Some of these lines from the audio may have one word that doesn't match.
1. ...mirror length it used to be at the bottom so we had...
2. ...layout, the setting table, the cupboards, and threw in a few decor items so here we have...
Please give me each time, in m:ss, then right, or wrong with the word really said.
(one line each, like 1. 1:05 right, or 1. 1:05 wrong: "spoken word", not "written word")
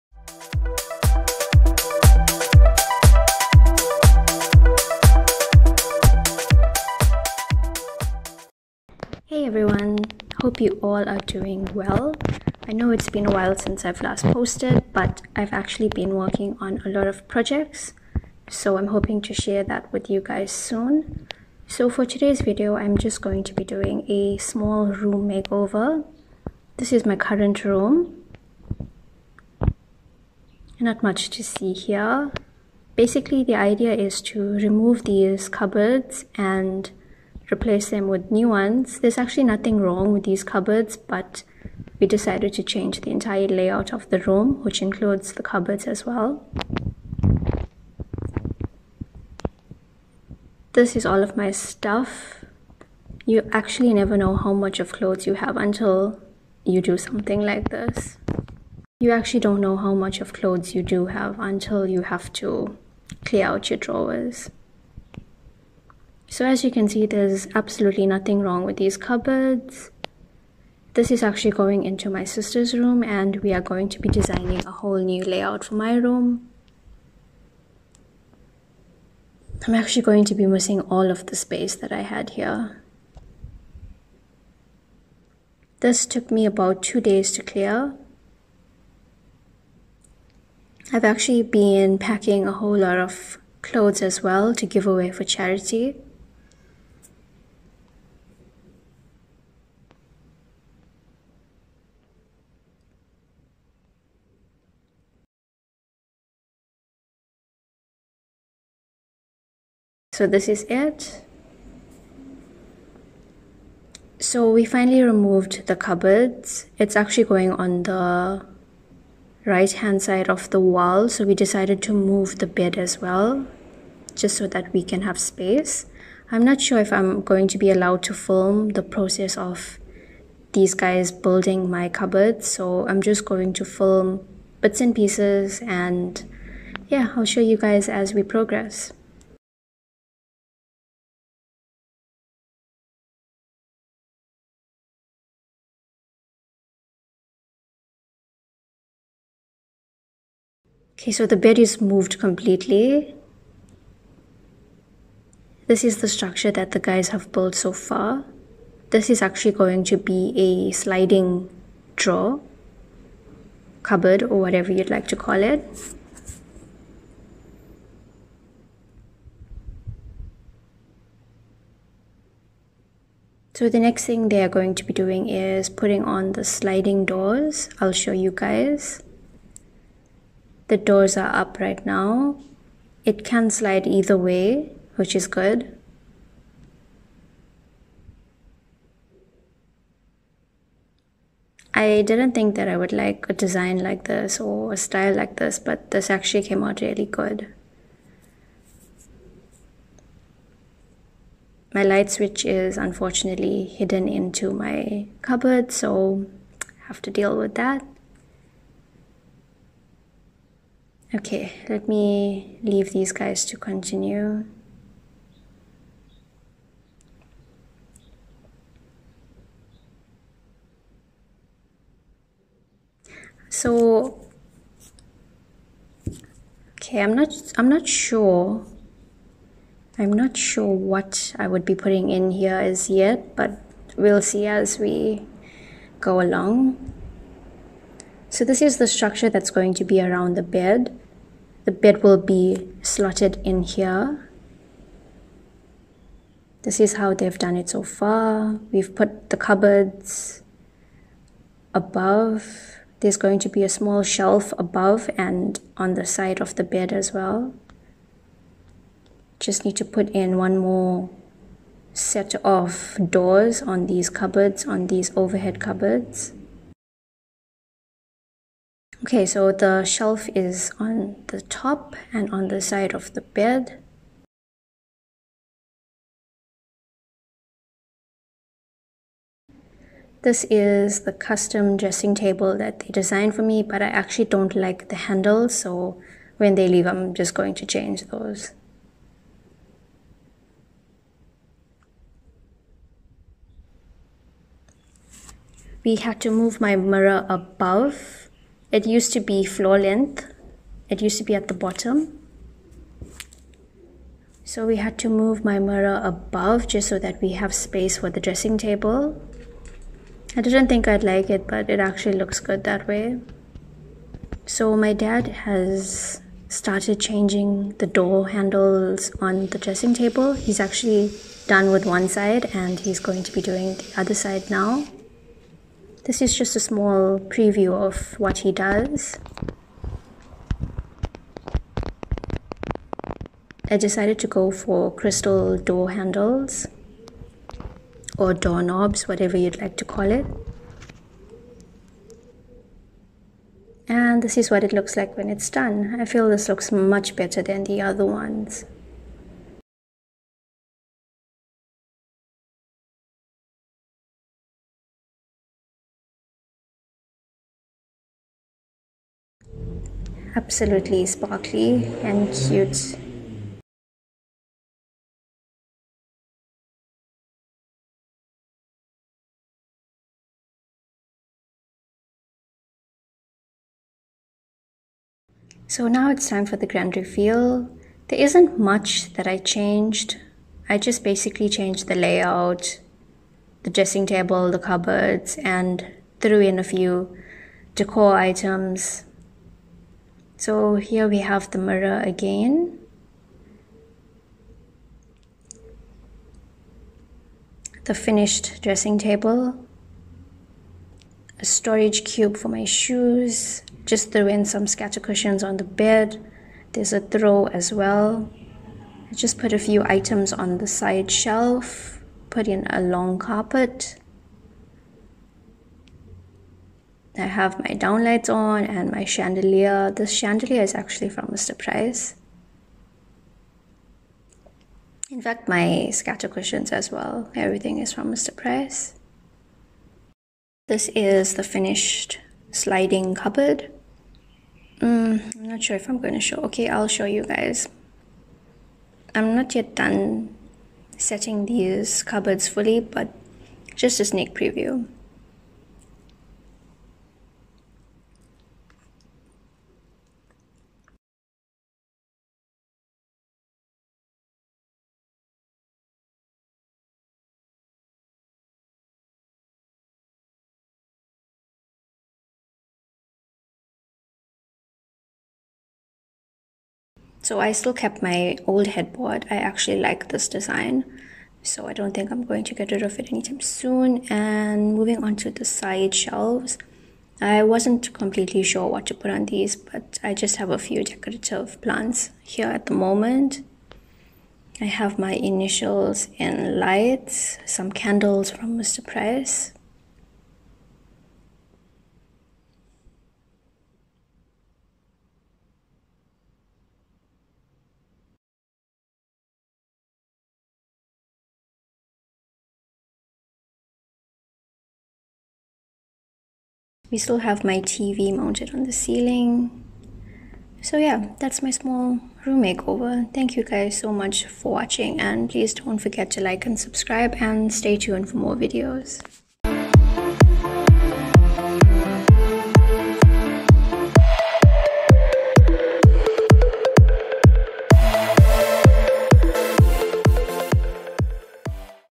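1. 4:59 wrong: "floor", not "mirror"
2. 6:21 wrong: "dressing", not "setting".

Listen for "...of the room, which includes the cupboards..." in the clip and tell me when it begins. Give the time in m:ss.
0:43.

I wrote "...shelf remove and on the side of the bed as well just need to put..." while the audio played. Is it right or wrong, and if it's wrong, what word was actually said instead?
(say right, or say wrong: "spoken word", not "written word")
wrong: "above", not "remove".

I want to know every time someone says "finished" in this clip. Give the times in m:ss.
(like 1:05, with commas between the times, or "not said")
6:37, 7:11.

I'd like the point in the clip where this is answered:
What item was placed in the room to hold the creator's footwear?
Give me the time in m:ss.
6:41.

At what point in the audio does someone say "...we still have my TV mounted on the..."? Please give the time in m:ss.
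8:26.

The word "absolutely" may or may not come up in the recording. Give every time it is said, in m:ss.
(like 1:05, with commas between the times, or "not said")
1:07, 6:00.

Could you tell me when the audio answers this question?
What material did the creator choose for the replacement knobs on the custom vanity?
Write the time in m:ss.
5:34.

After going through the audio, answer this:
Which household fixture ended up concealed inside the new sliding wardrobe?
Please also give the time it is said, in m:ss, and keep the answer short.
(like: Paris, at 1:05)
light switch, at 3:21.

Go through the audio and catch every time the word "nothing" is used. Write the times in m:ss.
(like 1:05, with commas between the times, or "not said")
0:39, 1:08.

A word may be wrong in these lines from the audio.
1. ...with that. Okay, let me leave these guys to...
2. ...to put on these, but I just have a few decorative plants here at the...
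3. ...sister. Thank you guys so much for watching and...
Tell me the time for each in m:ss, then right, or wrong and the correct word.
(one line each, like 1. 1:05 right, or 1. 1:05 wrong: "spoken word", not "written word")
1. 3:27 right
2. 7:58 right
3. 8:32 wrong: "makeover", not "sister".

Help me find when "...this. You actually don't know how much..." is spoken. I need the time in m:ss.
0:57.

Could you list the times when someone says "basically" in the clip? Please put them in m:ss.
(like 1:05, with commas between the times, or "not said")
0:32, 6:21.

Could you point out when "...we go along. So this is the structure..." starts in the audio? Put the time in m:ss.
3:54.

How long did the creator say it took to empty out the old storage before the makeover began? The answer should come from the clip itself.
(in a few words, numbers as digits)
2 days.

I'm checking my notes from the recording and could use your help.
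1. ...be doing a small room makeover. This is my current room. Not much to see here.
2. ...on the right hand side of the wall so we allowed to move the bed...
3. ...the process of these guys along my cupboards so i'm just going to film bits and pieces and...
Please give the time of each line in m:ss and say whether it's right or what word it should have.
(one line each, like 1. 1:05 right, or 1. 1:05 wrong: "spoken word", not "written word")
1. 0:23 right
2. 1:57 wrong: "decided", not "allowed"
3. 2:08 wrong: "building", not "along".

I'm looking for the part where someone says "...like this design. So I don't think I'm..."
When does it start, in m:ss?
7:49.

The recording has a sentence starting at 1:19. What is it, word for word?
I'm actually going to be missing all of the space that I had here.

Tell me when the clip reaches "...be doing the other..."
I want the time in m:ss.
5:23.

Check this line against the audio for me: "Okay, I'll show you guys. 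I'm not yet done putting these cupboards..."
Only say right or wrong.
wrong.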